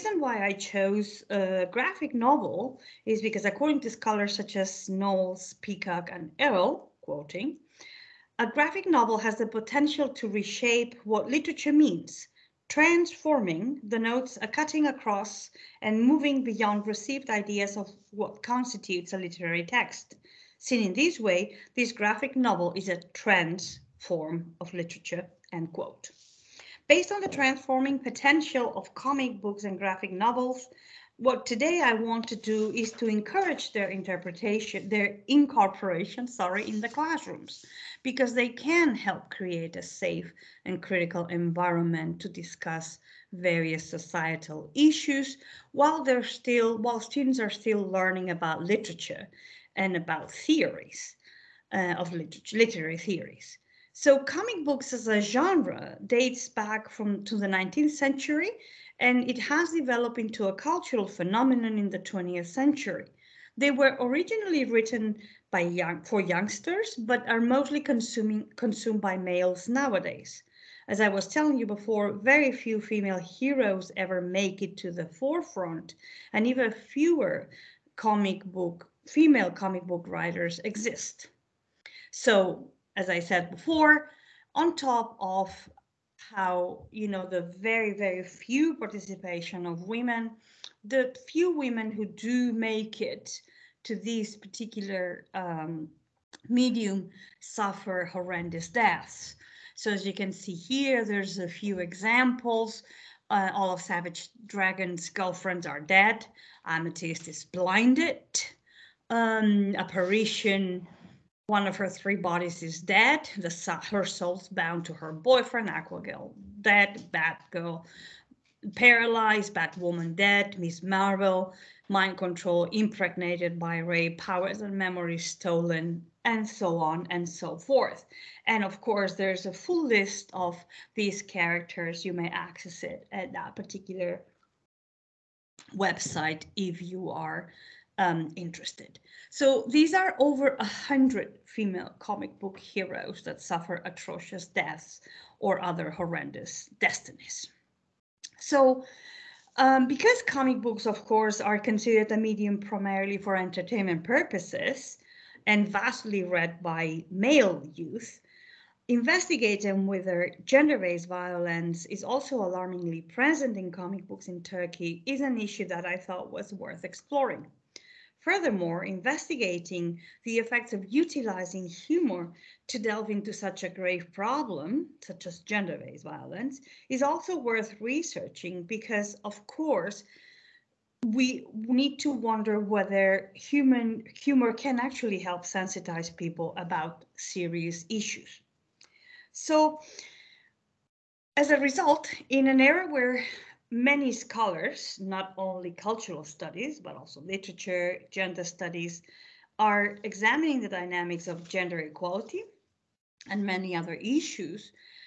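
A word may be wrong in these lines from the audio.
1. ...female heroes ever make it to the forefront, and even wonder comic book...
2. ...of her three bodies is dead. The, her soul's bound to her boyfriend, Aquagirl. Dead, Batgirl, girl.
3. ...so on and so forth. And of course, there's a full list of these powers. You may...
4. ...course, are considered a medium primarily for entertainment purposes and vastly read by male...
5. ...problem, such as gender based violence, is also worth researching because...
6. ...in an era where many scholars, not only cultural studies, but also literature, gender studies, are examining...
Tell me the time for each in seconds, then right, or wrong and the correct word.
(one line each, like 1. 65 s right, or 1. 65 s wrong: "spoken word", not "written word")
1. 72 s wrong: "fewer", not "wonder"
2. 111 s right
3. 126 s wrong: "characters", not "powers"
4. 151 s right
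5. 174 s right
6. 192 s right.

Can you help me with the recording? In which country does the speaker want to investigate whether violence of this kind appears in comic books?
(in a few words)
Turkey.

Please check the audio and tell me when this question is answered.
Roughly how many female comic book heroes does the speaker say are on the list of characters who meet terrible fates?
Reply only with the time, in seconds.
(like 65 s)
140 s.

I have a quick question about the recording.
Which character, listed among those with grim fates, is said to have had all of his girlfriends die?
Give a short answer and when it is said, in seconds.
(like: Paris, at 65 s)
Savage Dragon, at 103 s.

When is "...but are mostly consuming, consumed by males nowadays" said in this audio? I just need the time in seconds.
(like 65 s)
66 s.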